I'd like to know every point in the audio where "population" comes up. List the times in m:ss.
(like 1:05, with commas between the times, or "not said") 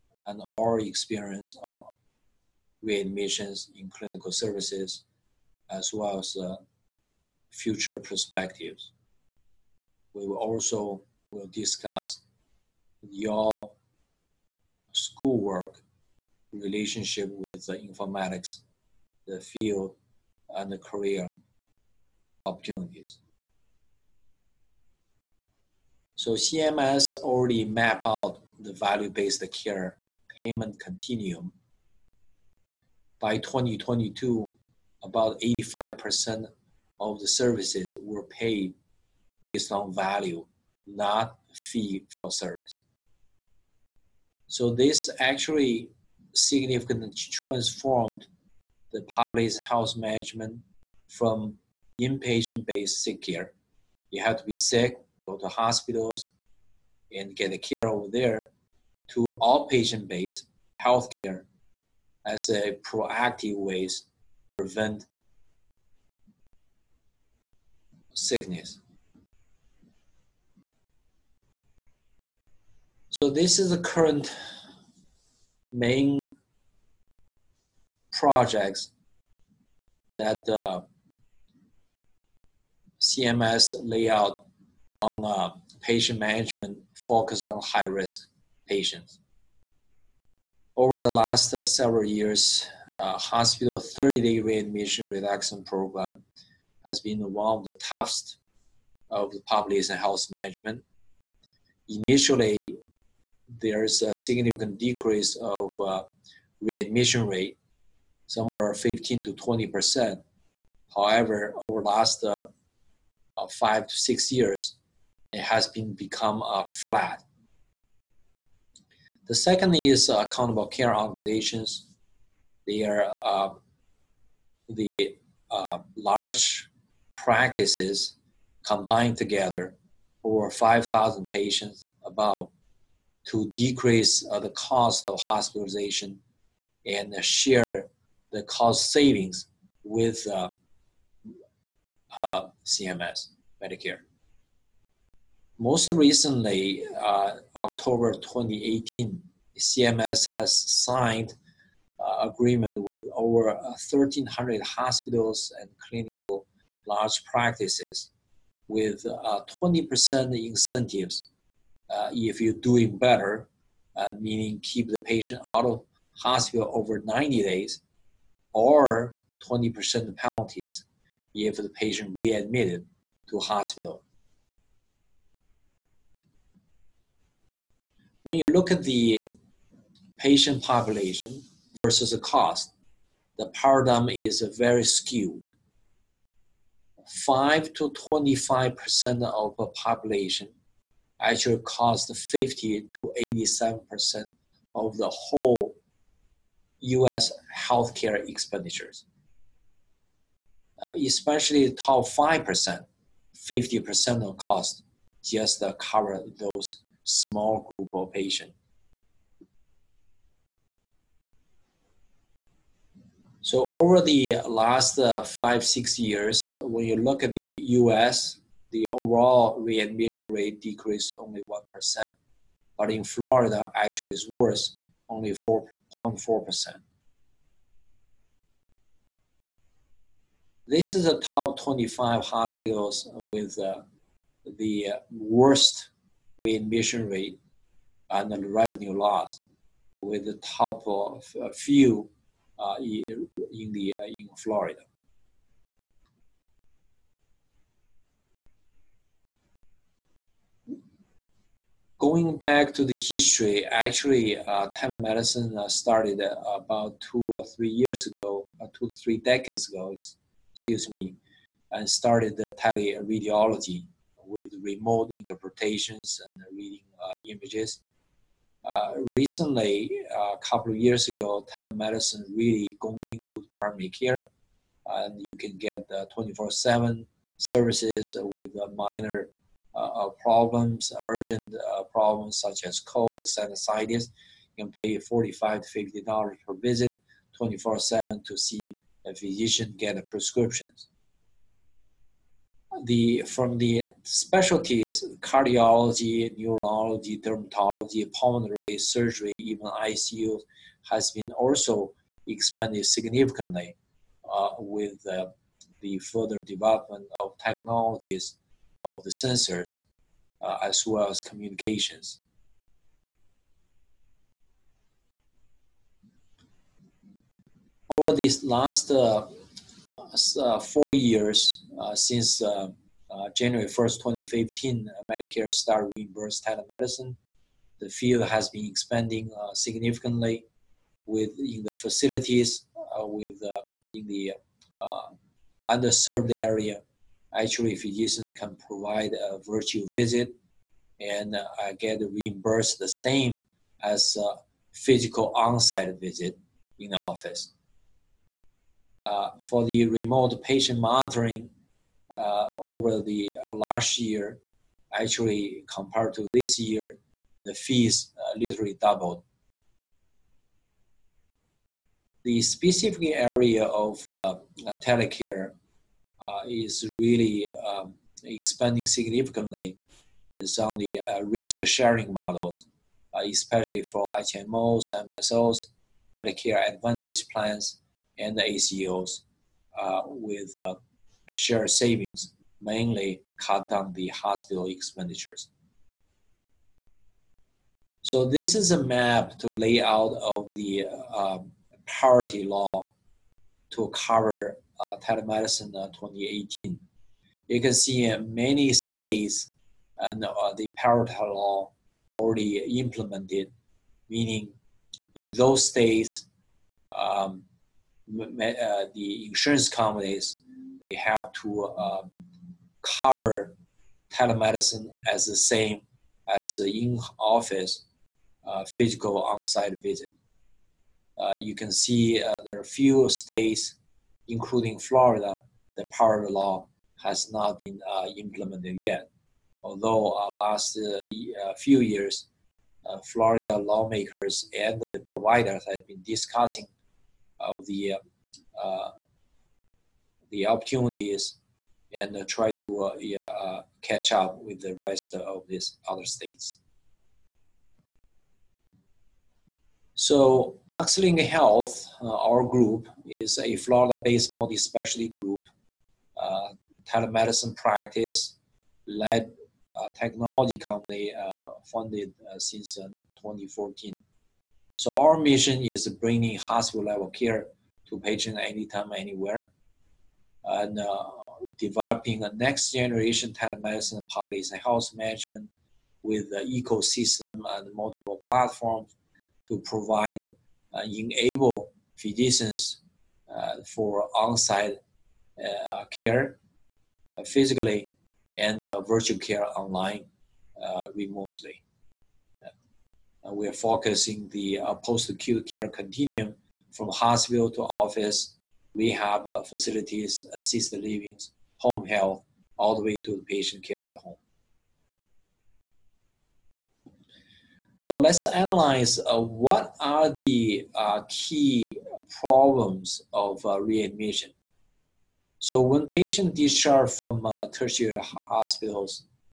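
1:39, 3:00, 3:09.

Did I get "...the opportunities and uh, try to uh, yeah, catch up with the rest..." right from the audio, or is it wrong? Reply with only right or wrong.
right.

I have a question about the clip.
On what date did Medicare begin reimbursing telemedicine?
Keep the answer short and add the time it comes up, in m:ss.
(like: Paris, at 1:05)
January 1st, 2015, at 5:23.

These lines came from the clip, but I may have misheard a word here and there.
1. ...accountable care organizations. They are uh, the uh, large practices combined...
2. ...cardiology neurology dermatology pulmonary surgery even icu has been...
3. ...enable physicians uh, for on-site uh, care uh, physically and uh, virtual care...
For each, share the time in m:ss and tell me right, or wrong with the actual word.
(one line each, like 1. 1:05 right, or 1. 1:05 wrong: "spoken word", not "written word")
1. 2:00 right
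2. 4:55 right
3. 8:00 right.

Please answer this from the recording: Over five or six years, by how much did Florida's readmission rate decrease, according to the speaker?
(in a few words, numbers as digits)
4.4%.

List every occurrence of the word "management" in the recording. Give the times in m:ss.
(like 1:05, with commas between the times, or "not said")
0:49, 1:26, 1:40, 7:54.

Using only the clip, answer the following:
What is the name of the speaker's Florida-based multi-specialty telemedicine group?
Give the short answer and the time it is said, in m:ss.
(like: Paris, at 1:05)
Doxling Health, at 7:30.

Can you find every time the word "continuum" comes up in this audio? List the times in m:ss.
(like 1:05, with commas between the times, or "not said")
0:30, 8:15.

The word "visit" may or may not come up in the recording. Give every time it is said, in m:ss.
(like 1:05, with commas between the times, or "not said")
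4:46, 5:39, 5:45, 6:59.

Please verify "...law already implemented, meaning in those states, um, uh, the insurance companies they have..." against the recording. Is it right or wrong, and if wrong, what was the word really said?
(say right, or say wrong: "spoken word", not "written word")
right.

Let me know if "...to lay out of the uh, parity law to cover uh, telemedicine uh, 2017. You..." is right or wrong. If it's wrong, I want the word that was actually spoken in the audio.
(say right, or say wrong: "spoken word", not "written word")
wrong: "2018", not "2017".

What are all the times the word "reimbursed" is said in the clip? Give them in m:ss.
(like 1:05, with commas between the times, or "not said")
5:25, 5:42.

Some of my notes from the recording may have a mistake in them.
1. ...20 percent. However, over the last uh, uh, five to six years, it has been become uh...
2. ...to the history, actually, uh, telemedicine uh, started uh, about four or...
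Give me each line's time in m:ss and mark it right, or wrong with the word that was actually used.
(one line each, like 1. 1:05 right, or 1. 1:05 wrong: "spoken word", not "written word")
1. 1:49 right
2. 4:12 wrong: "two", not "four".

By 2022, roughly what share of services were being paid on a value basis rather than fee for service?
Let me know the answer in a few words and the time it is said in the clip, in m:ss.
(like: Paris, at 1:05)
85%, at 0:35.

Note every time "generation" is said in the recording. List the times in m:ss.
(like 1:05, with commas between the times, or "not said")
7:52.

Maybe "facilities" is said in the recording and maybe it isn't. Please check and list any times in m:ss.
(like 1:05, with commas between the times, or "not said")
5:31, 8:19.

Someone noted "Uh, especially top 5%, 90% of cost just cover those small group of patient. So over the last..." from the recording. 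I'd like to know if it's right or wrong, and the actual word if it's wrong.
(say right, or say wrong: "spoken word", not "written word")
wrong: "50", not "90".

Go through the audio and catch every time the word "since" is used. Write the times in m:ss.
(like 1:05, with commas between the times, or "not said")
5:21, 7:42.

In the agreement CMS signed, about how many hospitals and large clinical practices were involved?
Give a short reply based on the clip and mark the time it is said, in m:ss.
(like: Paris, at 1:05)
1,300, at 2:33.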